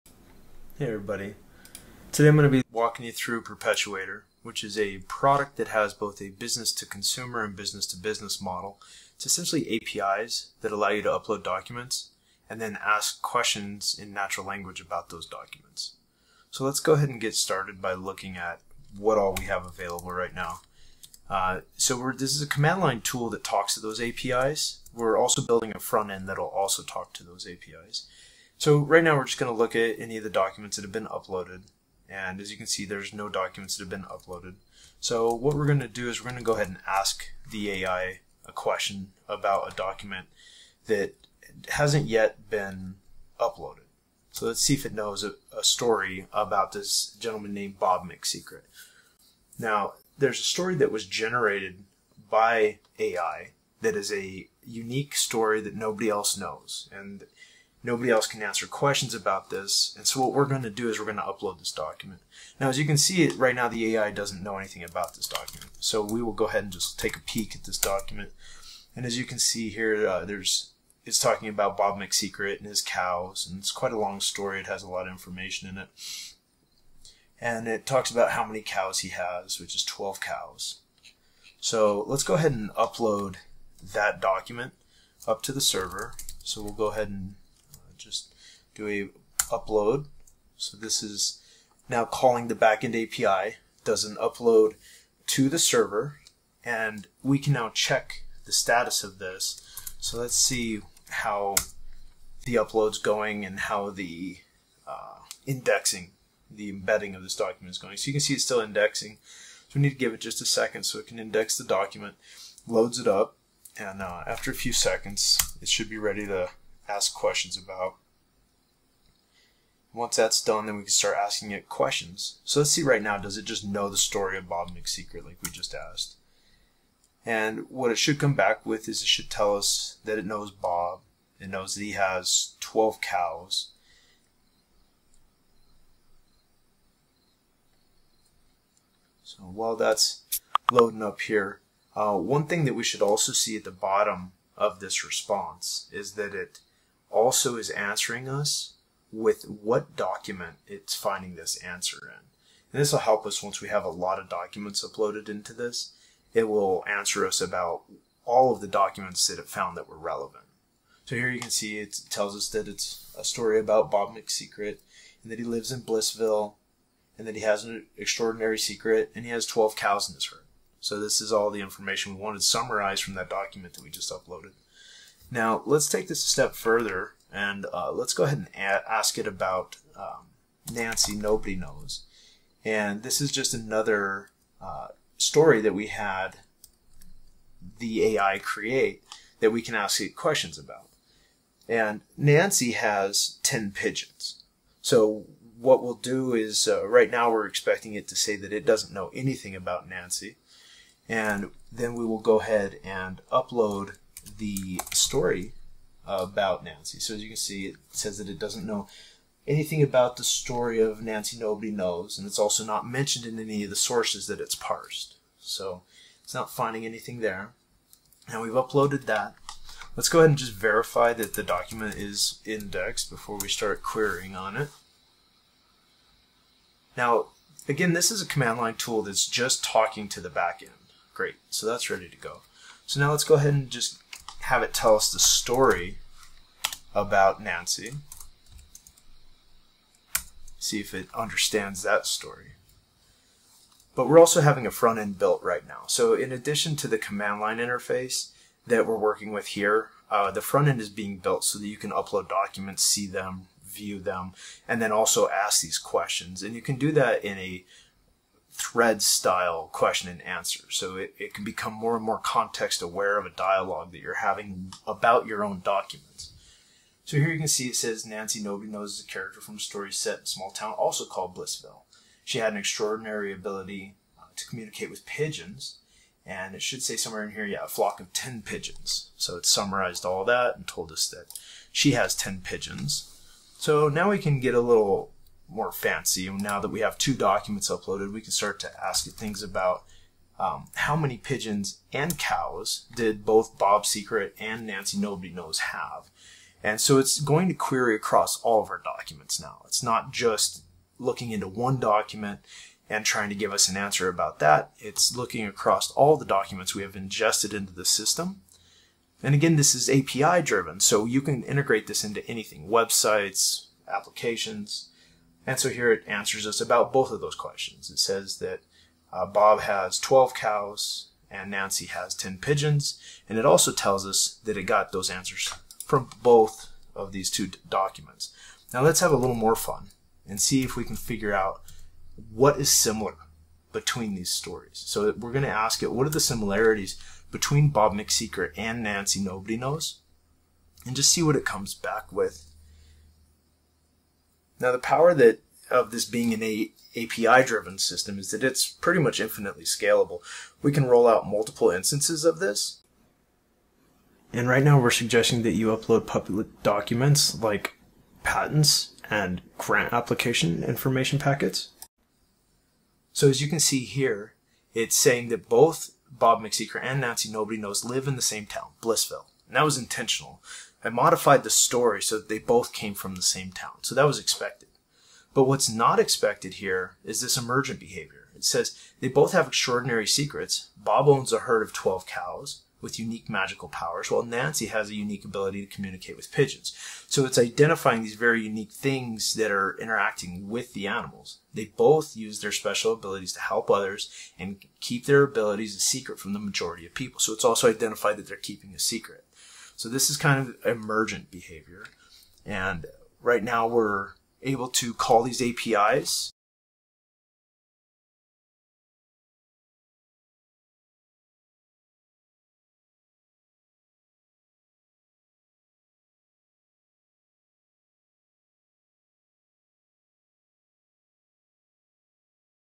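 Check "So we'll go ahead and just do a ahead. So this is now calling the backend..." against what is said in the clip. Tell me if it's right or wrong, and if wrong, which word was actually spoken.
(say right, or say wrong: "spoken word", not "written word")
wrong: "upload", not "ahead".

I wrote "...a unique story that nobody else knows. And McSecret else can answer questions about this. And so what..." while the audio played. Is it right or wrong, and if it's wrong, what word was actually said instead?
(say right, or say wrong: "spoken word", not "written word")
wrong: "Nobody", not "McSecret".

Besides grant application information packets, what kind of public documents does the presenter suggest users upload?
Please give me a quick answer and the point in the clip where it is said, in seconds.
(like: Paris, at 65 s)
Patents, at 358 s.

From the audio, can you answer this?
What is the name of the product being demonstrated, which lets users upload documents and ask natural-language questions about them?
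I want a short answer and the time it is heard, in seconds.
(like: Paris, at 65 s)
Perpetuator, at 3 s.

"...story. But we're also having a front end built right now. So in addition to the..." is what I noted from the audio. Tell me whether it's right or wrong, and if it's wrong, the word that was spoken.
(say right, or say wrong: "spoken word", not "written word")
right.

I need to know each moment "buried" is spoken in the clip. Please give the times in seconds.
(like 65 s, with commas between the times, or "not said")
not said.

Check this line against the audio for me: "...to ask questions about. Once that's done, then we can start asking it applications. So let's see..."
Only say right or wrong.
wrong.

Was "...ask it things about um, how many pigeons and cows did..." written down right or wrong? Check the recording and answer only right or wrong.
right.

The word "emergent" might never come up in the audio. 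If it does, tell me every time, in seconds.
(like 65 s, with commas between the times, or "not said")
377 s, 400 s.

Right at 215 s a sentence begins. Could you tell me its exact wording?
So it's not finding anything there.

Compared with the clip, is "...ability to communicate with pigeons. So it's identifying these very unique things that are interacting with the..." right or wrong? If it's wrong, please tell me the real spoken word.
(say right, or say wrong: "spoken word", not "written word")
right.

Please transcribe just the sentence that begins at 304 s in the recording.
It's looking across all the documents we have ingested into the system.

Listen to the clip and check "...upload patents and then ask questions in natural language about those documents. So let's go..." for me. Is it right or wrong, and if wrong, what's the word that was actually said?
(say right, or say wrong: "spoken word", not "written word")
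wrong: "documents", not "patents".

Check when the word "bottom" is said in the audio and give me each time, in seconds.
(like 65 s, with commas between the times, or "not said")
143 s.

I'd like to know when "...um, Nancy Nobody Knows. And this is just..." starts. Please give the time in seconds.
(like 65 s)
179 s.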